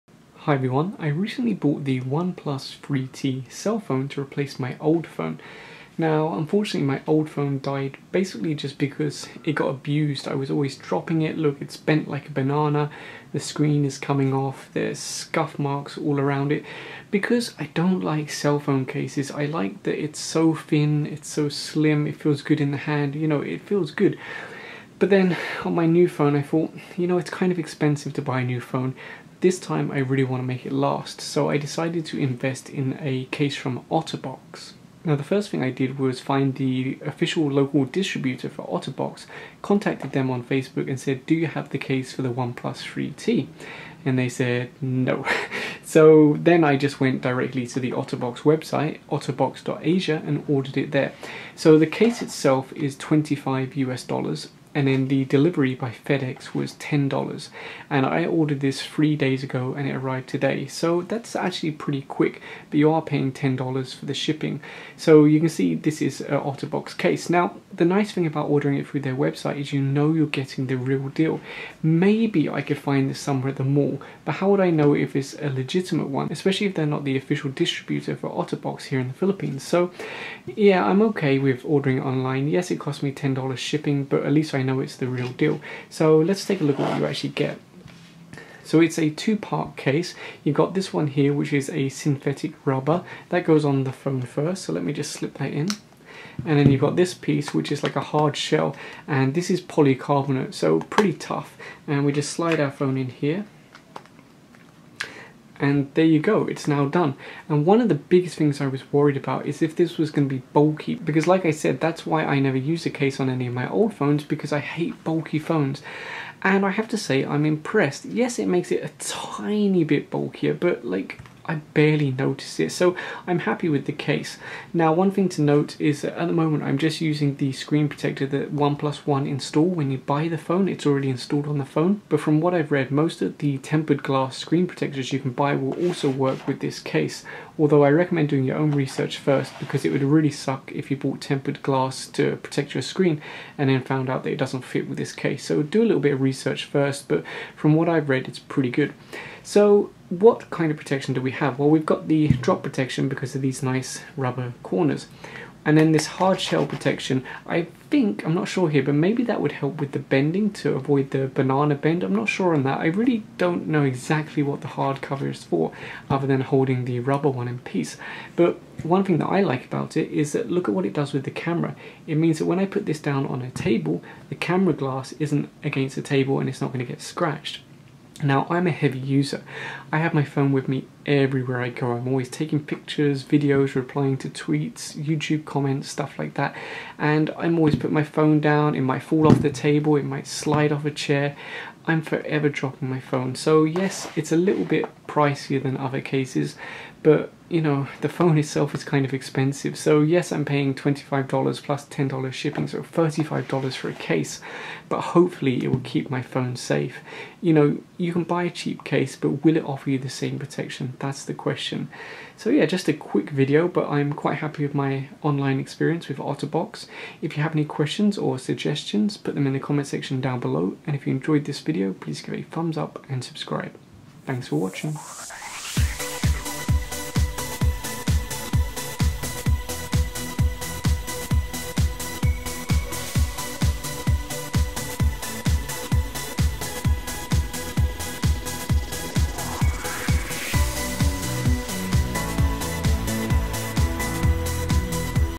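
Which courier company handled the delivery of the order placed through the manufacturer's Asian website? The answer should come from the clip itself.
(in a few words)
FedEx.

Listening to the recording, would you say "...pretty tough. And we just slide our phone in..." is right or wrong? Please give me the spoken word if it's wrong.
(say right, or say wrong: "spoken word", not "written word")
right.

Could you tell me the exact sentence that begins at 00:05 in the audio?
Now, unfortunately, my old phone died basically just because it got abused.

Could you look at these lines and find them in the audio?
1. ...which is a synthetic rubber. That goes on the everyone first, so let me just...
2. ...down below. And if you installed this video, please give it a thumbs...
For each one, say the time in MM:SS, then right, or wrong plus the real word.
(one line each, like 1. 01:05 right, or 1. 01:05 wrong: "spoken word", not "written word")
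1. 01:31 wrong: "phone", not "everyone"
2. 03:40 wrong: "enjoyed", not "installed".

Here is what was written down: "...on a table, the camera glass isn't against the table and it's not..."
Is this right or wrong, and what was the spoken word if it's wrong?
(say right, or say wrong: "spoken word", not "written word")
right.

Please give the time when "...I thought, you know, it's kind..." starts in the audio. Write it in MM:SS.
00:26.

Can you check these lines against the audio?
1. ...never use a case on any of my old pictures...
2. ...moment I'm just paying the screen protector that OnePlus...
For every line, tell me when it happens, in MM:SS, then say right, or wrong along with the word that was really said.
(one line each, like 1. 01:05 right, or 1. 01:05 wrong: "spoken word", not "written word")
1. 01:52 wrong: "phones", not "pictures"
2. 02:06 wrong: "using", not "paying".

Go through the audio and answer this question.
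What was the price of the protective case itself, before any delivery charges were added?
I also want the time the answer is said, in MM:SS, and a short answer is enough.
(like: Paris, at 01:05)
25 US dollars, at 00:52.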